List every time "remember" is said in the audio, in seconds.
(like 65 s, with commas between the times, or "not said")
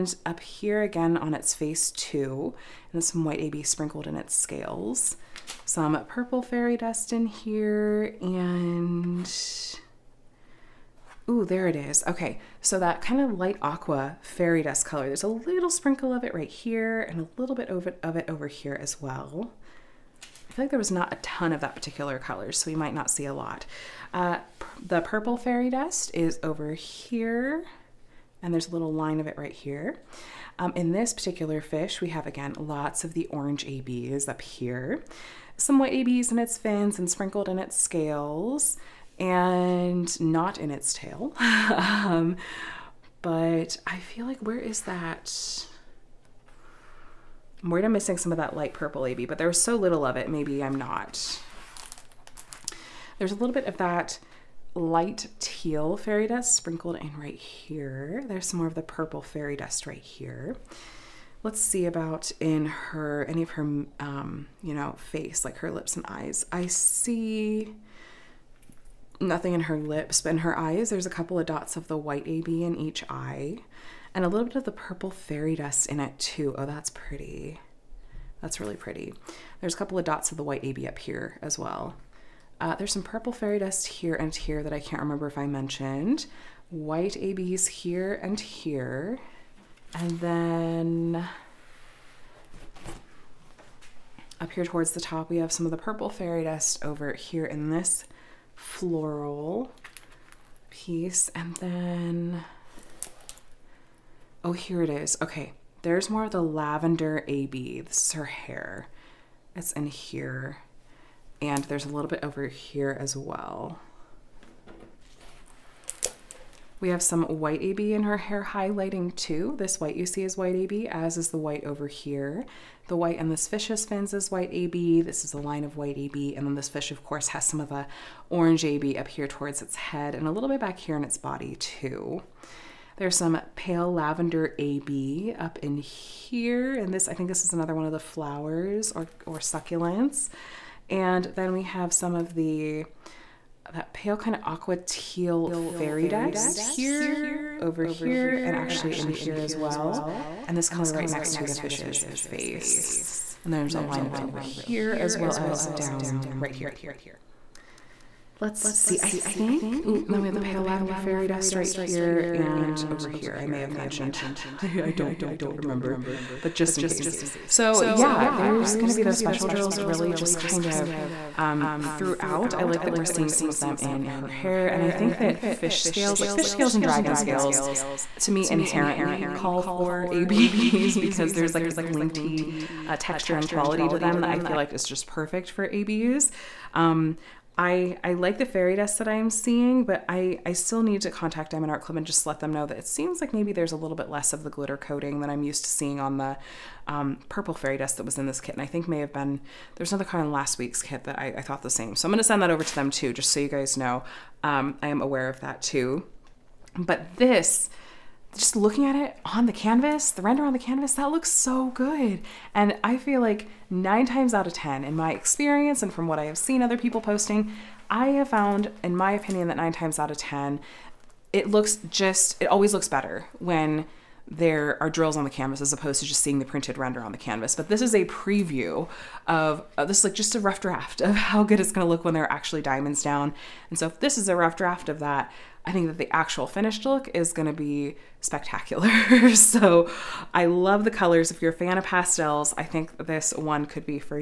85 s, 165 s.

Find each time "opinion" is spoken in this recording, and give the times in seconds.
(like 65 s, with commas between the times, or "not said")
219 s.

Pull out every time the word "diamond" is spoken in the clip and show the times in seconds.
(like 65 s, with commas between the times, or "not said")
191 s, 232 s.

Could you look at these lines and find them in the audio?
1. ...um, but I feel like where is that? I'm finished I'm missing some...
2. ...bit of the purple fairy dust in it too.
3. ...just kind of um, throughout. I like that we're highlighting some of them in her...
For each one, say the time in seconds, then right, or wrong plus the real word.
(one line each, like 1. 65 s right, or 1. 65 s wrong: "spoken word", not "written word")
1. 41 s wrong: "worried", not "finished"
2. 74 s right
3. 170 s wrong: "seeing", not "highlighting".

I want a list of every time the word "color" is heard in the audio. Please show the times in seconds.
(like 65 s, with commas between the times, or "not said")
14 s, 22 s, 150 s, 240 s.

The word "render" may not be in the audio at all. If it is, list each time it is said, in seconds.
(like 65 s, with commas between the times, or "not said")
210 s, 226 s.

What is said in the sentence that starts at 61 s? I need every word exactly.
Let's see about in her, any of her, um, you know, face, like her lips and eyes.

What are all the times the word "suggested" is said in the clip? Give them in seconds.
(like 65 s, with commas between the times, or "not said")
not said.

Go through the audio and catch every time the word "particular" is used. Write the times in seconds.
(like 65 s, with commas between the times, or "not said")
21 s, 31 s.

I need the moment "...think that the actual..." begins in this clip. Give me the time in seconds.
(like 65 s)
235 s.